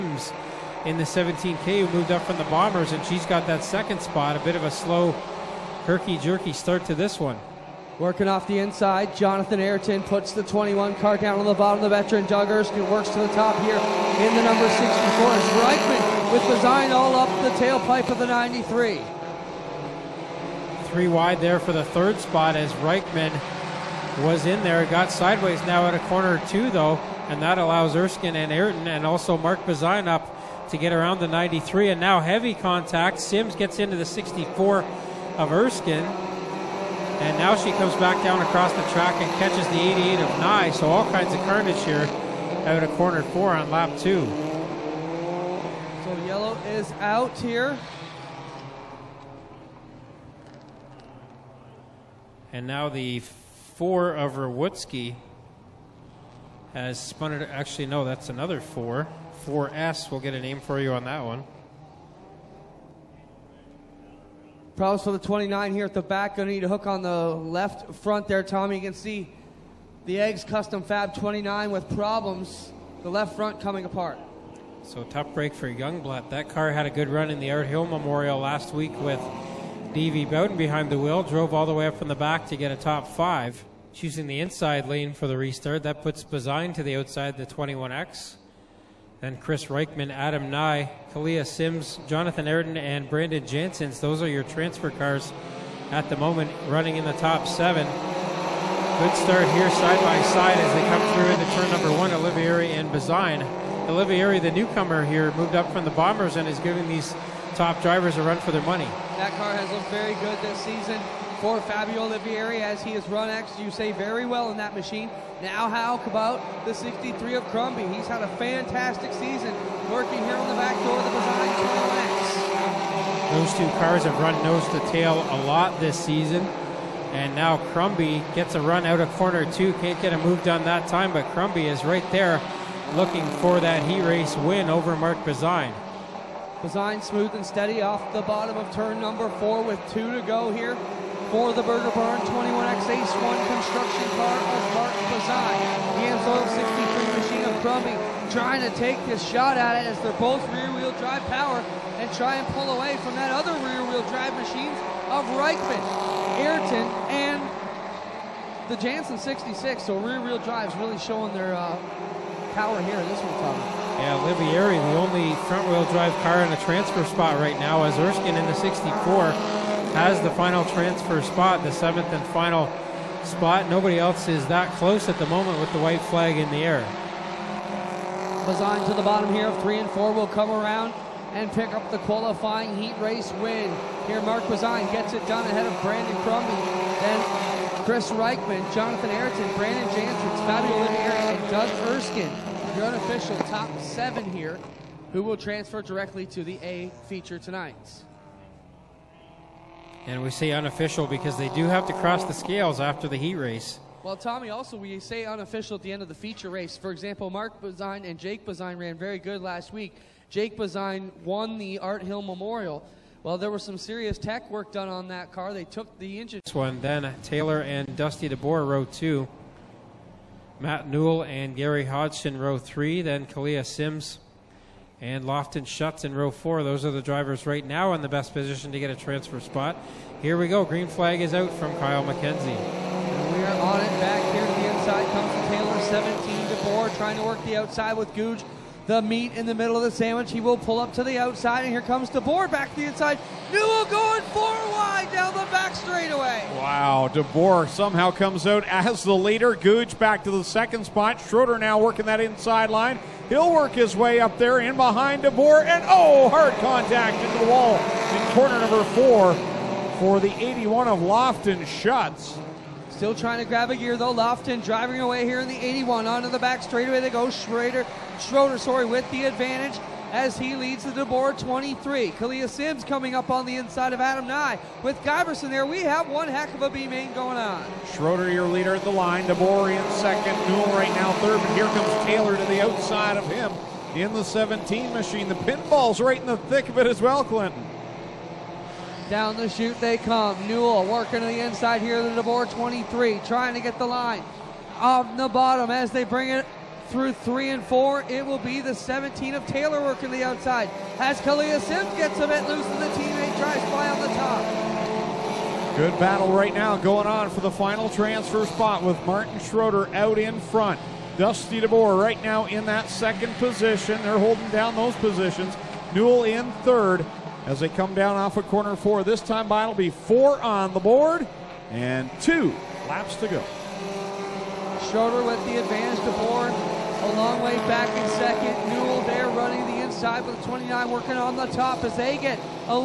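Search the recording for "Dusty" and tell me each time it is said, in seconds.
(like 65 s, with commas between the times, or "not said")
217 s, 311 s.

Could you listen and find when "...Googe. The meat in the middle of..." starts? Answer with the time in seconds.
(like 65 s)
238 s.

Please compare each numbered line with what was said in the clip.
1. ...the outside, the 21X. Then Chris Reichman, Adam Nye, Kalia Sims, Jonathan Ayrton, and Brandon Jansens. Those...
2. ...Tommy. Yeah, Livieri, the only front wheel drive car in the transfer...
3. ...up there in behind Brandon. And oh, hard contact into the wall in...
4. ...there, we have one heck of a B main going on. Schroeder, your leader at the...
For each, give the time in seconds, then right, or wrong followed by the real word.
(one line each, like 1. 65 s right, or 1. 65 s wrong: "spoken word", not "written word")
1. 86 s right
2. 163 s right
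3. 254 s wrong: "DeBoer", not "Brandon"
4. 275 s right.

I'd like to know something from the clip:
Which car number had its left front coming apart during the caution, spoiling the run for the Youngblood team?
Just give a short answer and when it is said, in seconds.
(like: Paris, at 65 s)
29, at 73 s.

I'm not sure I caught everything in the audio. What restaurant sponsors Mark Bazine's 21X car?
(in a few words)
Burger Barn.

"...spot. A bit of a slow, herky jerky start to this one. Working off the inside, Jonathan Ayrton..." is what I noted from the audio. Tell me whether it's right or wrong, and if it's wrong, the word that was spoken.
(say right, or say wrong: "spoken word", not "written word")
right.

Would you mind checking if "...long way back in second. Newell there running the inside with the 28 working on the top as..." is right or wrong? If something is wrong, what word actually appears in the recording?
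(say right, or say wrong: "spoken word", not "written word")
wrong: "29", not "28".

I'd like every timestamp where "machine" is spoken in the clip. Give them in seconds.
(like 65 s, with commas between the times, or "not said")
114 s, 147 s, 154 s, 284 s.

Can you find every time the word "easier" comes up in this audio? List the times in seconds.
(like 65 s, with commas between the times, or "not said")
not said.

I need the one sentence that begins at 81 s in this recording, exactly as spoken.
Drove all the way up from the back to get a top five.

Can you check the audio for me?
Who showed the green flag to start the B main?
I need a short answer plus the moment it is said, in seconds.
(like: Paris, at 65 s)
Kyle McKenzie, at 231 s.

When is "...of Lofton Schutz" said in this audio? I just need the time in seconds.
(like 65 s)
260 s.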